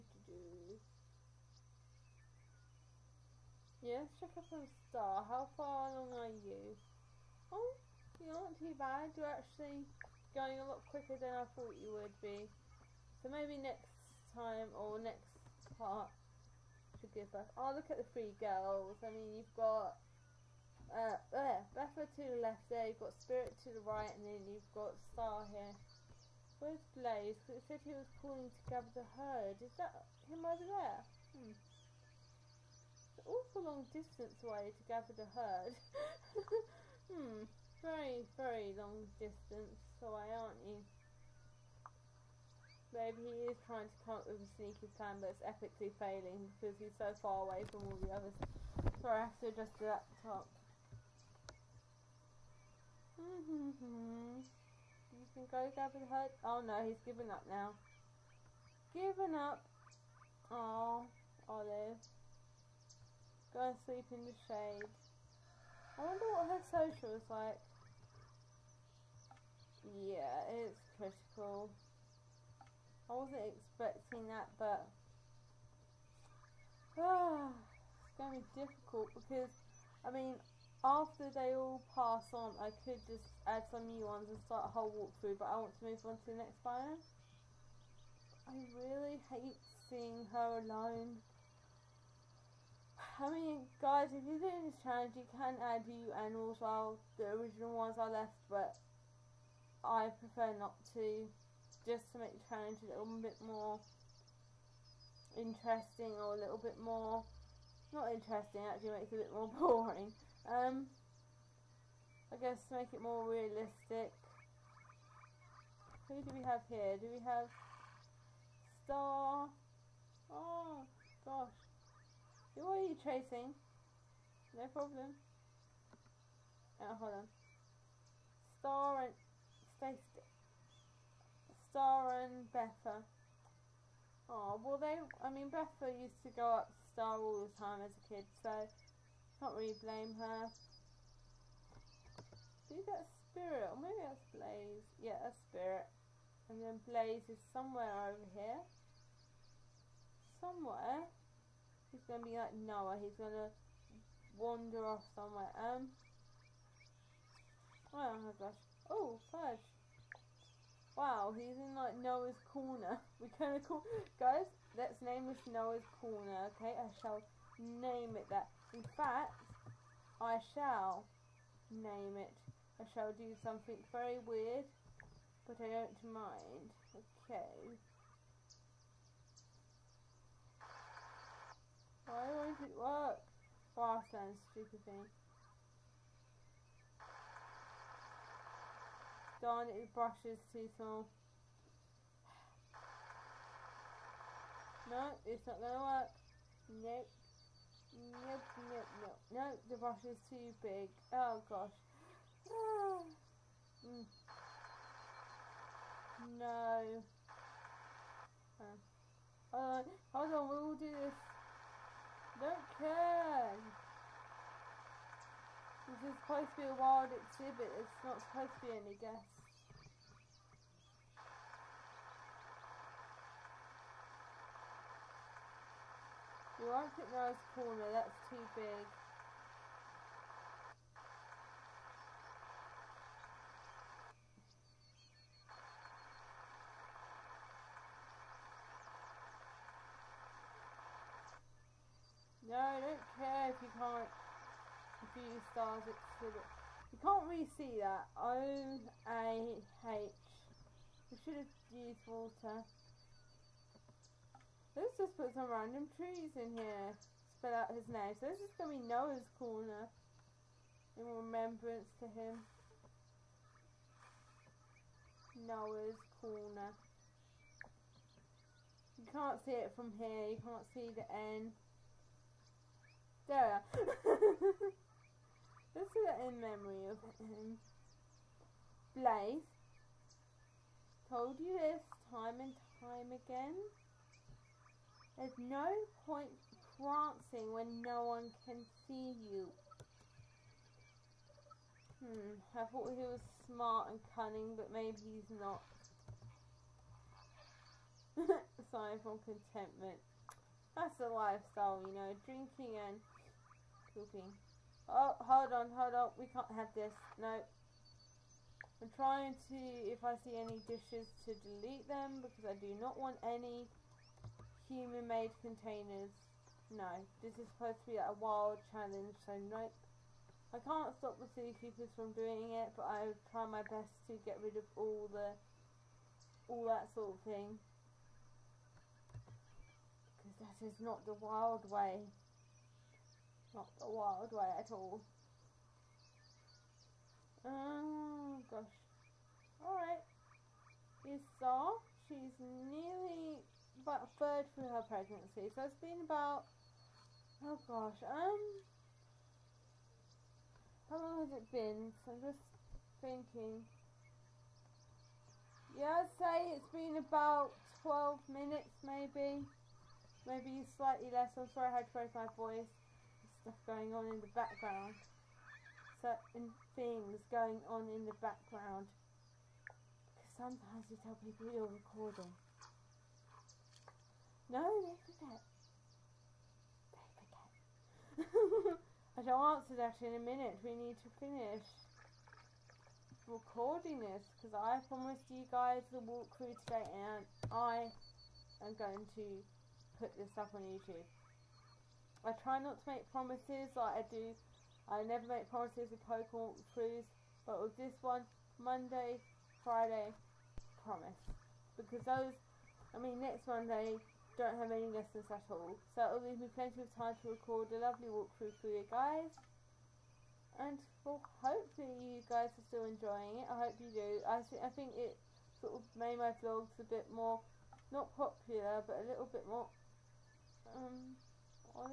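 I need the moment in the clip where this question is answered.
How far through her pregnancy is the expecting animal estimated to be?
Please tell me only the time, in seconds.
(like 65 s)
344 s.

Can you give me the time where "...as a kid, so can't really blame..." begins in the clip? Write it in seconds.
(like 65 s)
137 s.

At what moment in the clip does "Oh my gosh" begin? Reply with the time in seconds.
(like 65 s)
157 s.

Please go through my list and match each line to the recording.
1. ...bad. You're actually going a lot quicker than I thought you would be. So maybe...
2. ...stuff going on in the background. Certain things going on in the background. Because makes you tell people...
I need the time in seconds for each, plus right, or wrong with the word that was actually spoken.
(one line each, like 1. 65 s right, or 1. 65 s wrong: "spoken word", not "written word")
1. 8 s right
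2. 363 s wrong: "sometimes", not "makes".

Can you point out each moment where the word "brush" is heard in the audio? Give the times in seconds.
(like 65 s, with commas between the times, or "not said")
189 s, 199 s.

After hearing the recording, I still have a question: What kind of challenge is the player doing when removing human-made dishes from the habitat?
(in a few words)
Wild challenge.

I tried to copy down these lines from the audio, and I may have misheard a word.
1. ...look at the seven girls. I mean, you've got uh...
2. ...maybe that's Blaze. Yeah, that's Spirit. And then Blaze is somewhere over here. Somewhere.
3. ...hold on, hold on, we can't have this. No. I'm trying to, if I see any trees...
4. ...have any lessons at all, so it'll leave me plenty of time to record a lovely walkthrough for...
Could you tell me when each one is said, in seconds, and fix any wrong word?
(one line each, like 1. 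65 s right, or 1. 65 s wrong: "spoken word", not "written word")
1. 17 s wrong: "three", not "seven"
2. 143 s right
3. 305 s wrong: "dishes", not "trees"
4. 404 s right.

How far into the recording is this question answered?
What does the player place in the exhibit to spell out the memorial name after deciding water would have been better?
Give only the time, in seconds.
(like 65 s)
255 s.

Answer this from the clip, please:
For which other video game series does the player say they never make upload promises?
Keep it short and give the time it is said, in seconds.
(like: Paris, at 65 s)
Pokemon, at 396 s.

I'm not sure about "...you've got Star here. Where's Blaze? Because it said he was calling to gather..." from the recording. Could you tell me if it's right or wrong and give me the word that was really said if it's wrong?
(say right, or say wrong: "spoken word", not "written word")
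right.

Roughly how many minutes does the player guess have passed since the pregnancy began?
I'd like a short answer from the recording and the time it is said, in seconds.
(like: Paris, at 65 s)
12, at 357 s.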